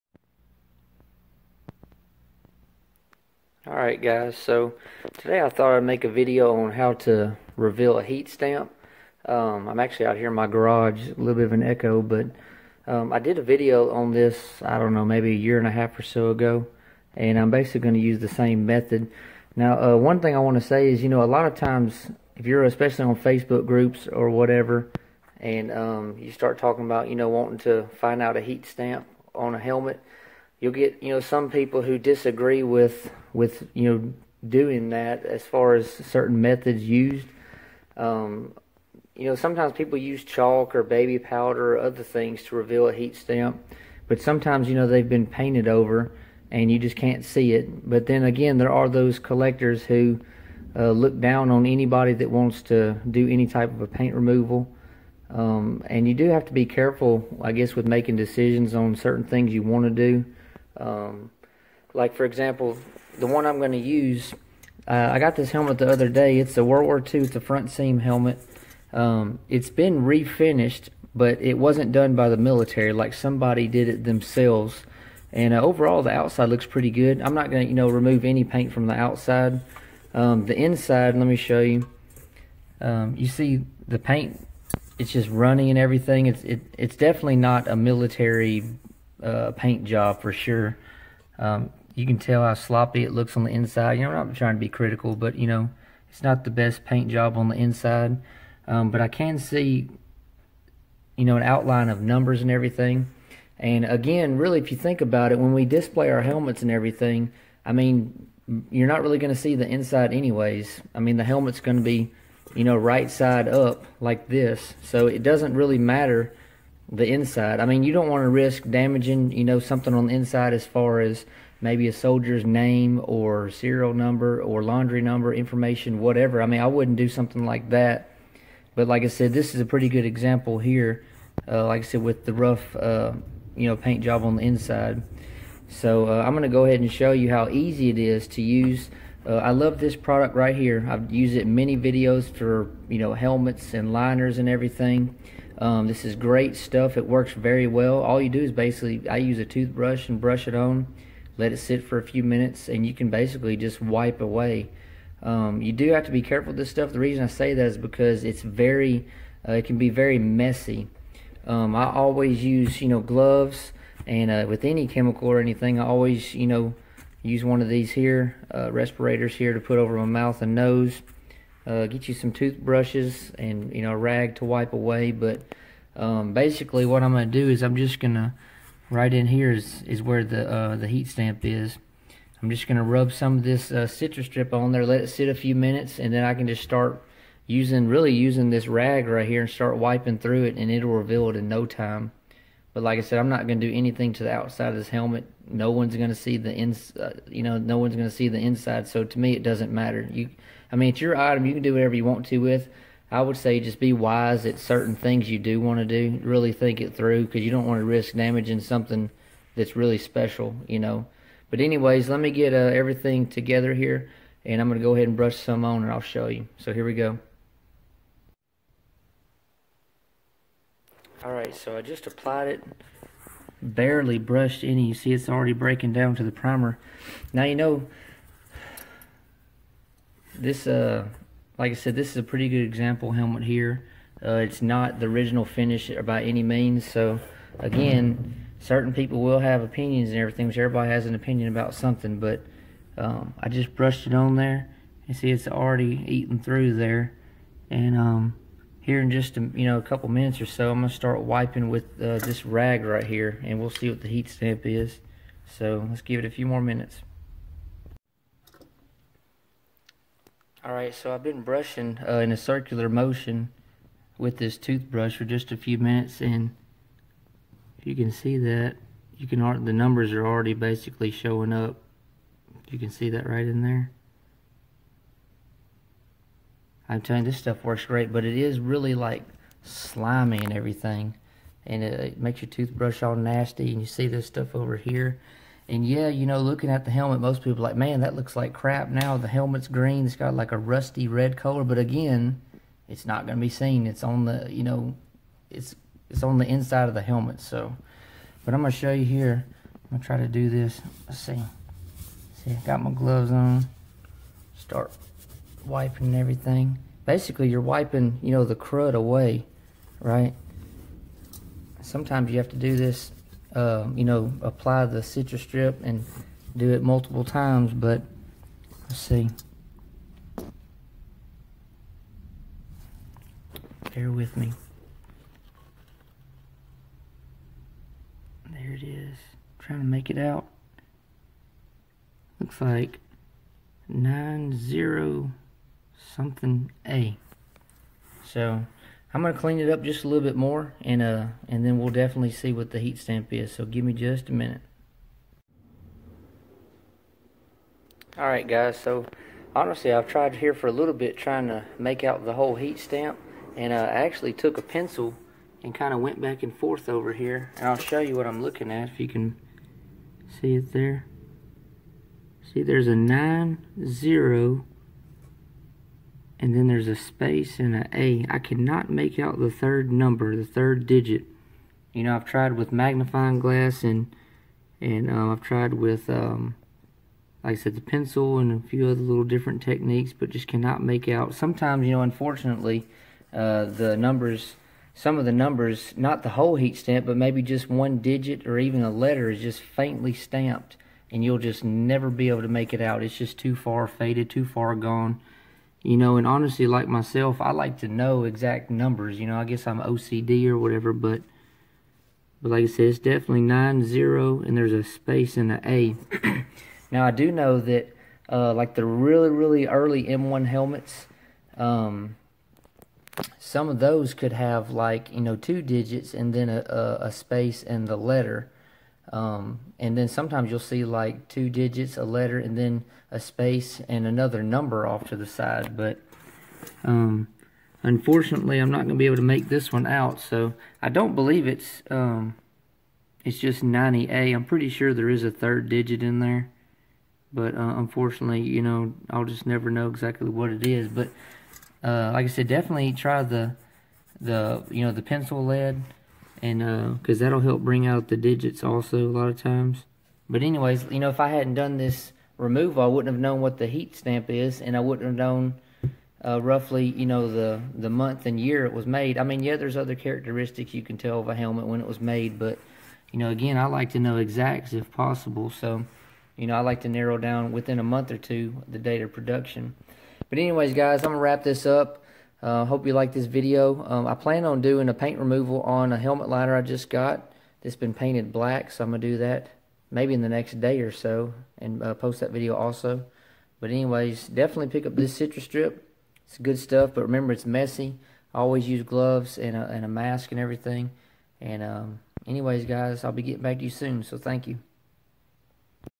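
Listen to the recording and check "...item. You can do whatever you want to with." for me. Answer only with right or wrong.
right.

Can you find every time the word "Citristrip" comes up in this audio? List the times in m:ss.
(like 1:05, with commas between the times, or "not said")
3:03, 5:15, 8:05.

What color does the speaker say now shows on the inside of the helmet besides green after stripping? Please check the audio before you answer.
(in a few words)
rusty red.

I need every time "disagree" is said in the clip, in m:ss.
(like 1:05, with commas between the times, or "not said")
0:31.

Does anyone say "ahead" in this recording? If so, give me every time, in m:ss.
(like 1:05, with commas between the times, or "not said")
2:16, 3:34.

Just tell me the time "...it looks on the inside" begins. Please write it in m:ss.
1:33.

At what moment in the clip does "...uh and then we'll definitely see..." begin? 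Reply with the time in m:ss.
5:41.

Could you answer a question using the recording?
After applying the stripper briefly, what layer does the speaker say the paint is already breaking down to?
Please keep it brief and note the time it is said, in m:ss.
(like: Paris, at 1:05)
primer, at 3:46.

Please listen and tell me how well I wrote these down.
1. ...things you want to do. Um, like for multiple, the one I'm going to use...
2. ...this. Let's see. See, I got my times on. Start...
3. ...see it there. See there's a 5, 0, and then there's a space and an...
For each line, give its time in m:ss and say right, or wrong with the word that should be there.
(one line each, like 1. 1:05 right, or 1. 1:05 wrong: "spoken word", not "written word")
1. 0:59 wrong: "example", not "multiple"
2. 5:00 wrong: "gloves", not "times"
3. 6:00 wrong: "9", not "5".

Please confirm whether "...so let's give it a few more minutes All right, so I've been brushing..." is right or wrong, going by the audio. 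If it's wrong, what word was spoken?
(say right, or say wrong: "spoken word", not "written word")
right.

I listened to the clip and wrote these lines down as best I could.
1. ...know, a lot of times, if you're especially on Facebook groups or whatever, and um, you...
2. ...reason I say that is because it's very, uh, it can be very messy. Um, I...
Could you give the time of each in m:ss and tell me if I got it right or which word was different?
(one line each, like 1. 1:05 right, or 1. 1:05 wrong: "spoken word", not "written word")
1. 0:21 right
2. 2:36 right.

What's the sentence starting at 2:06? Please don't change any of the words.
I mean, I wouldn't do something like that.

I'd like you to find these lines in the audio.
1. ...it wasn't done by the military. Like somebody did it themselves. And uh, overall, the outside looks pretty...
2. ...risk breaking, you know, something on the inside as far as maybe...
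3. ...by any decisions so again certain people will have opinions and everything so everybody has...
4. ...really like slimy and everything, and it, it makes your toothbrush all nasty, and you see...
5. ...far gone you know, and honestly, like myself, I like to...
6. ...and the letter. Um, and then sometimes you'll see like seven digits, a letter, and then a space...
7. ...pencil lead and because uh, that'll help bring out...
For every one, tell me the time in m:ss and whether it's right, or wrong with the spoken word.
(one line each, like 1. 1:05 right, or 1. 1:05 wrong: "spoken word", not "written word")
1. 1:11 right
2. 1:58 wrong: "damaging", not "breaking"
3. 3:56 wrong: "means", not "decisions"
4. 4:38 right
5. 6:34 right
6. 6:57 wrong: "two", not "seven"
7. 7:25 right.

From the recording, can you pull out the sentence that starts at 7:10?
So I don't believe it's um, it's just 90A.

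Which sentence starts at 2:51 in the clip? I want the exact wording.
Uh, get you some toothbrushes and you know a rag to wipe away.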